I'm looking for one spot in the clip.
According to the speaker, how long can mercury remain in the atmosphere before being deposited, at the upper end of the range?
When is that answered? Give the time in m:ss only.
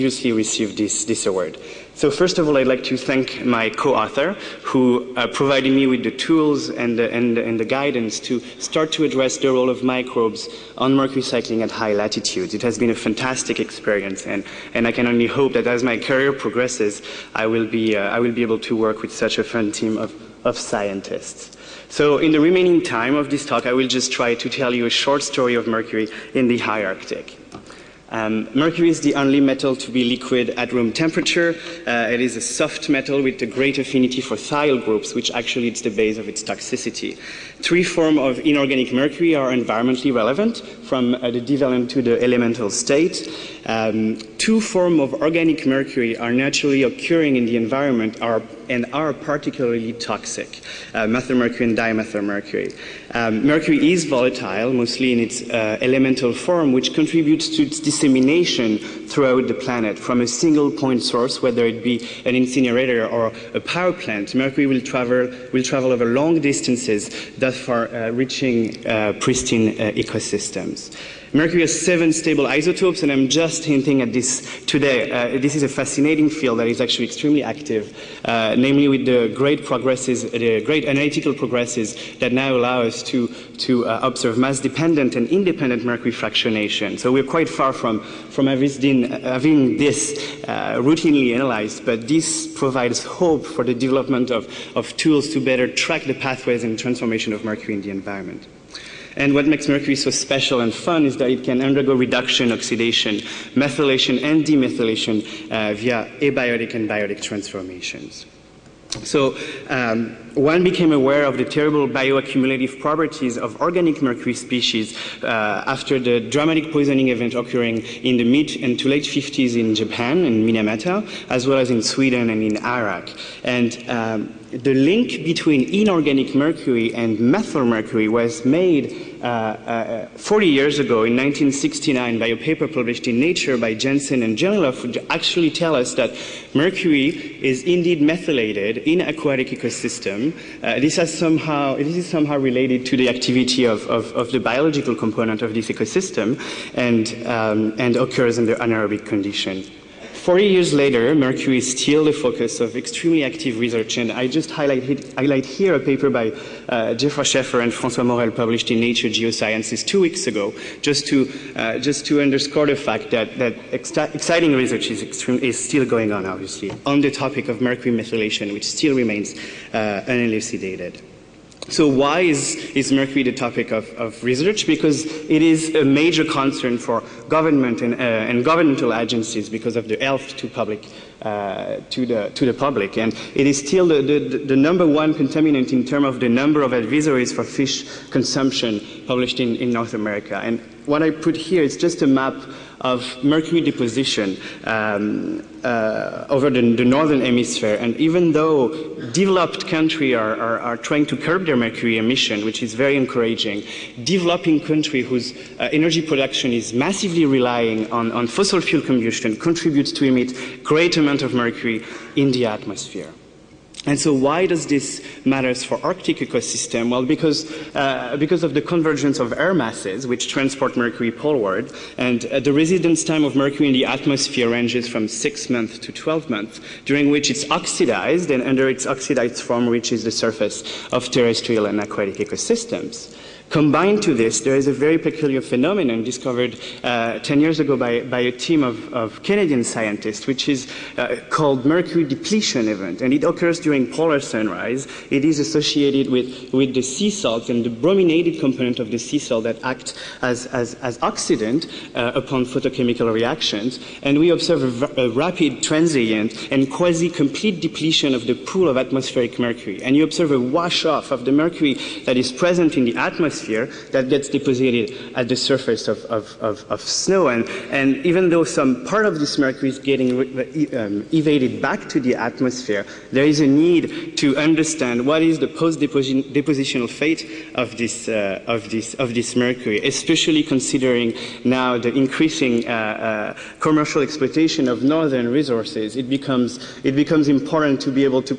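3:45.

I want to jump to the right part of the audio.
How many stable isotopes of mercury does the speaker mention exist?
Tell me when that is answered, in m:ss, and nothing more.
1:11.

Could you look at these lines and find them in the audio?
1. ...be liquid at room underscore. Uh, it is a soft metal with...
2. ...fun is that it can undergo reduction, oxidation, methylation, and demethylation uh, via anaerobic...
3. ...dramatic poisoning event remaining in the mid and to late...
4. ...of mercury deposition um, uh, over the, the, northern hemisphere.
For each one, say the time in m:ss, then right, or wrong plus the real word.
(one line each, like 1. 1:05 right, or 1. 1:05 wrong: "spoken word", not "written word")
1. 0:29 wrong: "temperature", not "underscore"
2. 1:40 wrong: "abiotic", not "anaerobic"
3. 1:56 wrong: "occurring", not "remaining"
4. 3:12 right.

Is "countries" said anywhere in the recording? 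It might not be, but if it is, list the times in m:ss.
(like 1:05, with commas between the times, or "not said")
3:19, 3:24.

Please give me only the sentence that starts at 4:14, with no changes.
And we observe a, a rapid, transient, and quasi-complete depletion of the pool of atmospheric mercury.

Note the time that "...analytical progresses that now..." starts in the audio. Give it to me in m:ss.
1:20.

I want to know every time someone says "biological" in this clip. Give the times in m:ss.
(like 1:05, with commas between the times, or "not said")
2:24.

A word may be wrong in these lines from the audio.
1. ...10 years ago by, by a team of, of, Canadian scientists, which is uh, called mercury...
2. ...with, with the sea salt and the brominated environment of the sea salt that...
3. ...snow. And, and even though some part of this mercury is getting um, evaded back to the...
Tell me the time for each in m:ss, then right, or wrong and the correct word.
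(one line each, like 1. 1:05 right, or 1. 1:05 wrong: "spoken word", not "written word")
1. 3:57 right
2. 4:06 wrong: "component", not "environment"
3. 4:26 right.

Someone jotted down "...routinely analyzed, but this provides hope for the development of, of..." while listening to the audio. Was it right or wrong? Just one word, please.
right.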